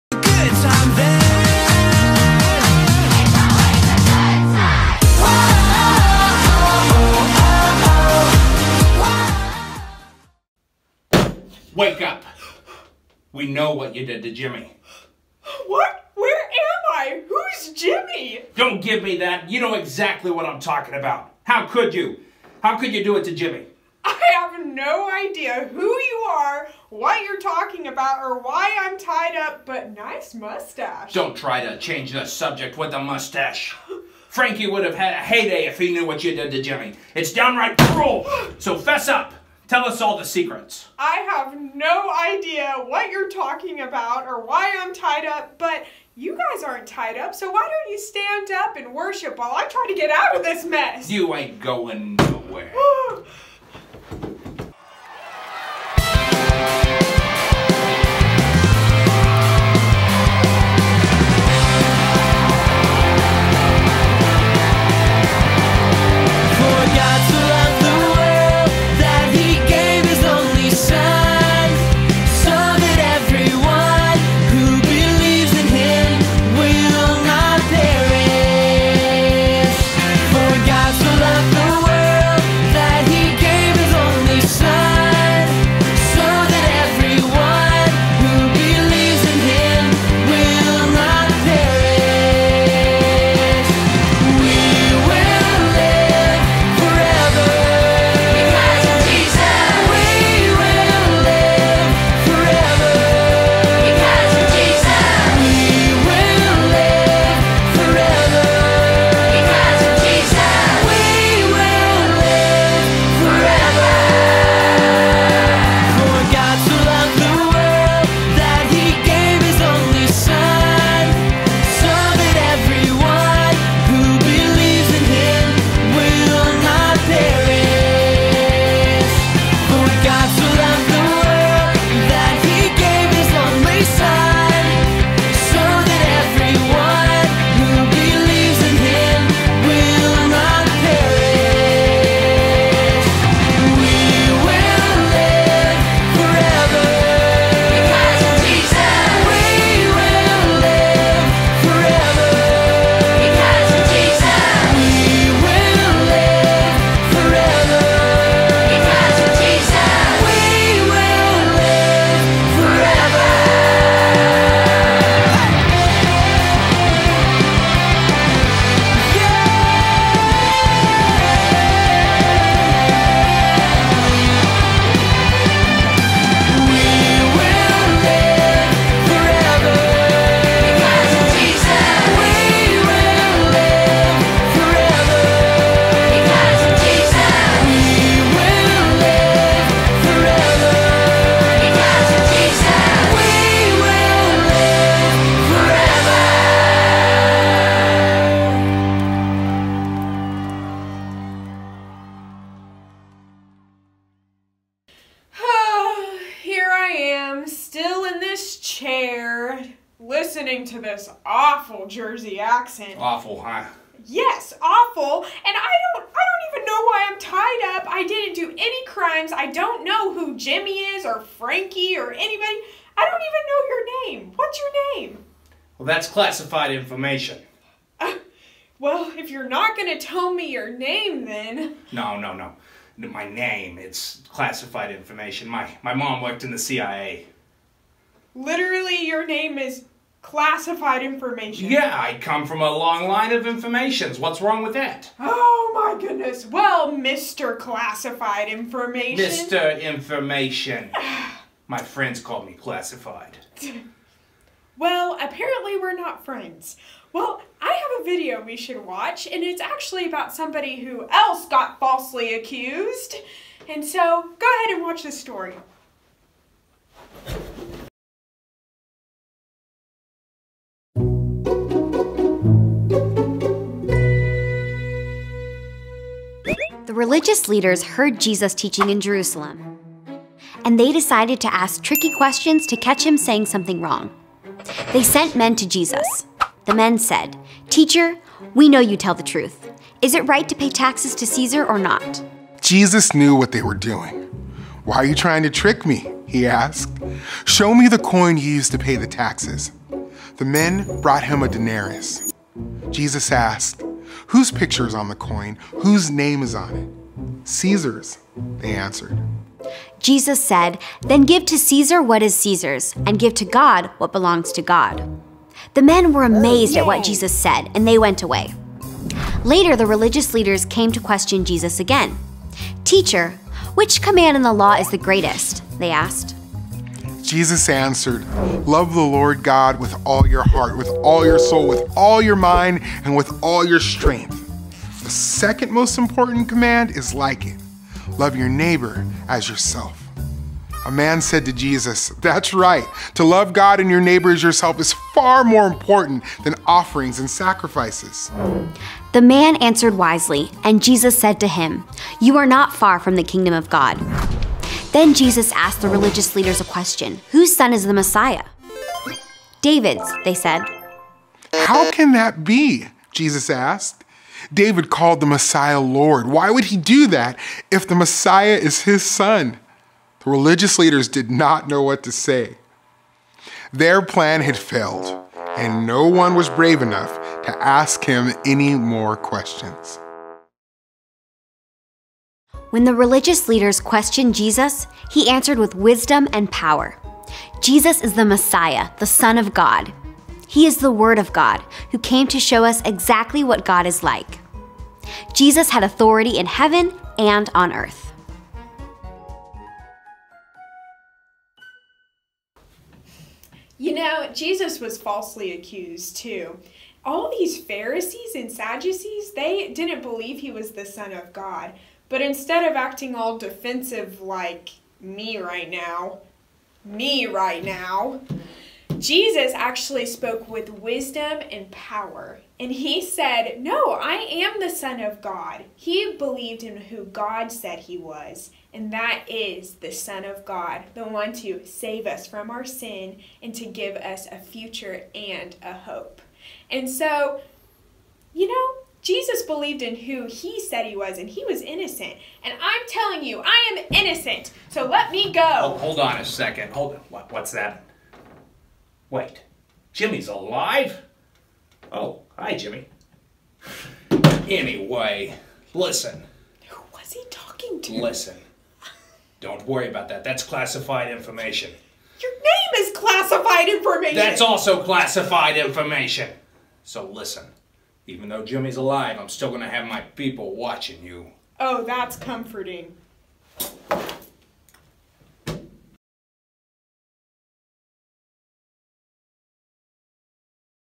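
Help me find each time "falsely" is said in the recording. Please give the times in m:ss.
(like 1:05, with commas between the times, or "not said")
4:21, 6:44.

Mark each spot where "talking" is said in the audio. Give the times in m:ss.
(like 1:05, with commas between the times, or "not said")
0:20, 0:27, 0:43, 7:37.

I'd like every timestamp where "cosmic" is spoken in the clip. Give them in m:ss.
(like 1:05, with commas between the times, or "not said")
not said.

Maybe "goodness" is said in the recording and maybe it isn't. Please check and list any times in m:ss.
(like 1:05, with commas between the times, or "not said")
4:06.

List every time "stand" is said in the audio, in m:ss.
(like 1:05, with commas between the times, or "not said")
0:47.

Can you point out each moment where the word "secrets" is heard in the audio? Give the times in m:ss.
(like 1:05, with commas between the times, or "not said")
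0:40.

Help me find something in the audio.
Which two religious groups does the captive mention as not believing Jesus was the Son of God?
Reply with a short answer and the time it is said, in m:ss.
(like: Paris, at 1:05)
Pharisees and Sadducees, at 6:47.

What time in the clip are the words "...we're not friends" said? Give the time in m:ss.
4:15.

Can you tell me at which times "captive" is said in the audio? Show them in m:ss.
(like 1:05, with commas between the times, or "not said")
not said.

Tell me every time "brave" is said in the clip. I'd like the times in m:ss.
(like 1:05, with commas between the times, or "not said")
6:16.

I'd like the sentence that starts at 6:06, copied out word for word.
Why would he do that if the Messiah is his son?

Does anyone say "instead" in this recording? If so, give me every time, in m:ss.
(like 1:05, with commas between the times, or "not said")
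6:52.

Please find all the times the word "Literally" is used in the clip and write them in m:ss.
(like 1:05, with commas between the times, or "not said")
3:58.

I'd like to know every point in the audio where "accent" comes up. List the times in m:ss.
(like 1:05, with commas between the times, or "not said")
3:32.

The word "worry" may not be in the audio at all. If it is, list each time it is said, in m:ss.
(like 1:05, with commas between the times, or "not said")
7:39.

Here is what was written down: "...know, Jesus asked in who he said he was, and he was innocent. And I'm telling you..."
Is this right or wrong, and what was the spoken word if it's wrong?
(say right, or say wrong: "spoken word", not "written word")
wrong: "believed", not "asked".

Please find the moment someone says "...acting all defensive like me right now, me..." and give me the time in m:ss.
6:52.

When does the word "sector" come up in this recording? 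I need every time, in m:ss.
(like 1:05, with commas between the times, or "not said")
not said.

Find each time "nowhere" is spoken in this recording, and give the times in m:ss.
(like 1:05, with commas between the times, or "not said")
0:52.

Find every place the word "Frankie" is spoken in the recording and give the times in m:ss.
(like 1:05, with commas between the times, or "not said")
0:34, 3:41.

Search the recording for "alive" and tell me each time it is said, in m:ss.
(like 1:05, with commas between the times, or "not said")
7:30, 7:48.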